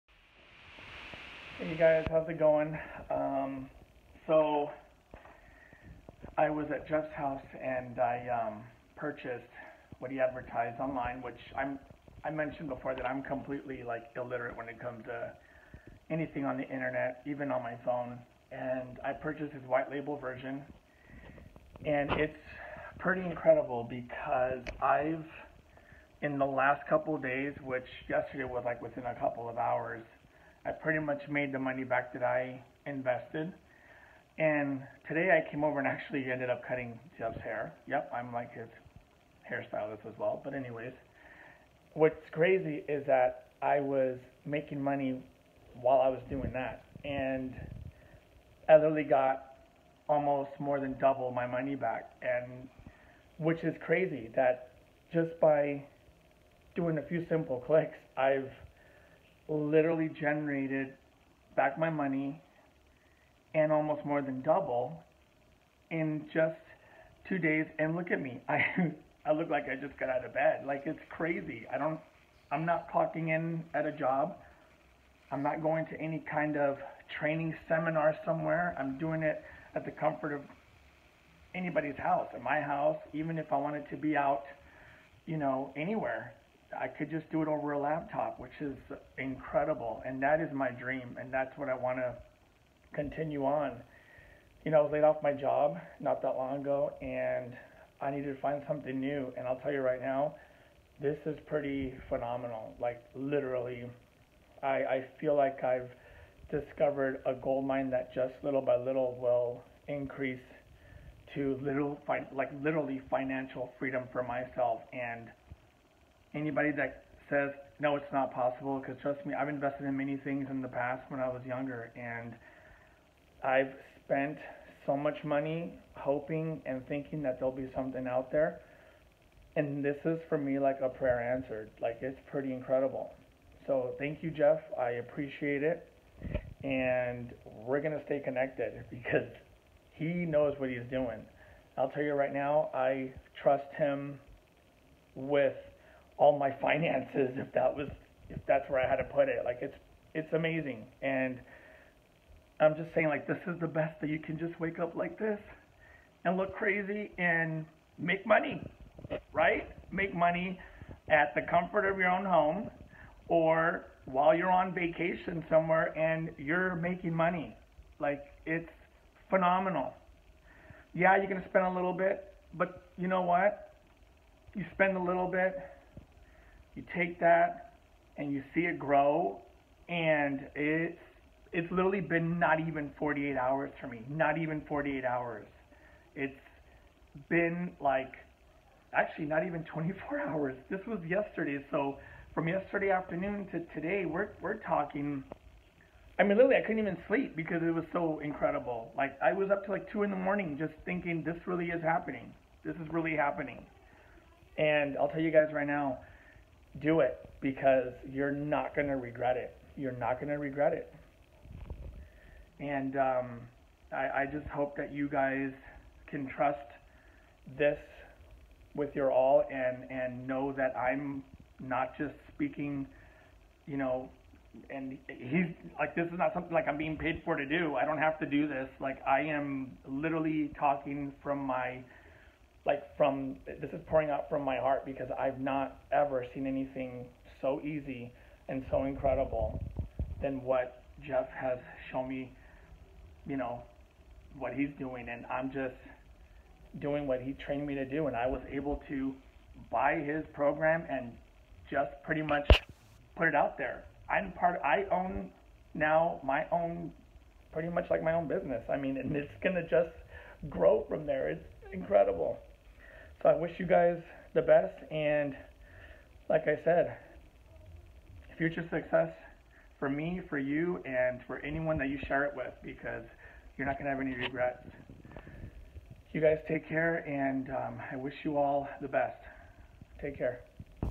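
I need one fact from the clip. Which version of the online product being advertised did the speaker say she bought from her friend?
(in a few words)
White label version.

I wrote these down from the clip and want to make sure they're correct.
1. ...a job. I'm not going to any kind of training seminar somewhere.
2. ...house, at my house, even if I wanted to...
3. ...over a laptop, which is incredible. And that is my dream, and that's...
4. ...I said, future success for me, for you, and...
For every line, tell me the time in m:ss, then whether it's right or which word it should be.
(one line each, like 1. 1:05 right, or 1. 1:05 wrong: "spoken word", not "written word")
1. 1:13 right
2. 1:21 right
3. 1:27 right
4. 4:26 right.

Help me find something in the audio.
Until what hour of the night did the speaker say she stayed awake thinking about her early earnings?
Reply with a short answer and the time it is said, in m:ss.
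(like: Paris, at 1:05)
2 in the morning, at 3:19.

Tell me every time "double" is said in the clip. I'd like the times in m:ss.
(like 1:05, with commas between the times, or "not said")
0:50, 1:04.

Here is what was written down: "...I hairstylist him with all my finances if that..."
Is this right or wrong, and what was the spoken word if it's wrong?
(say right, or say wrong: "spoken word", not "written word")
wrong: "trust", not "hairstylist".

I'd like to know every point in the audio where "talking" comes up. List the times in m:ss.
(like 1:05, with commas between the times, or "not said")
3:14, 3:50.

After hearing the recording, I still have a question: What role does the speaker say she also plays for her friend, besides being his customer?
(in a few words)
Hairstylist.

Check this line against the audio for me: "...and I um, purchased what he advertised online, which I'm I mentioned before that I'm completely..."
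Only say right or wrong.
right.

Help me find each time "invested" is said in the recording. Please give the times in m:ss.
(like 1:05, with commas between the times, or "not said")
0:32, 1:59.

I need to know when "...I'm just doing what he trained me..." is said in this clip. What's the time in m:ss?
4:05.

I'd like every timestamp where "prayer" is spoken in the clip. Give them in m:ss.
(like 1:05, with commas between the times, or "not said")
2:10.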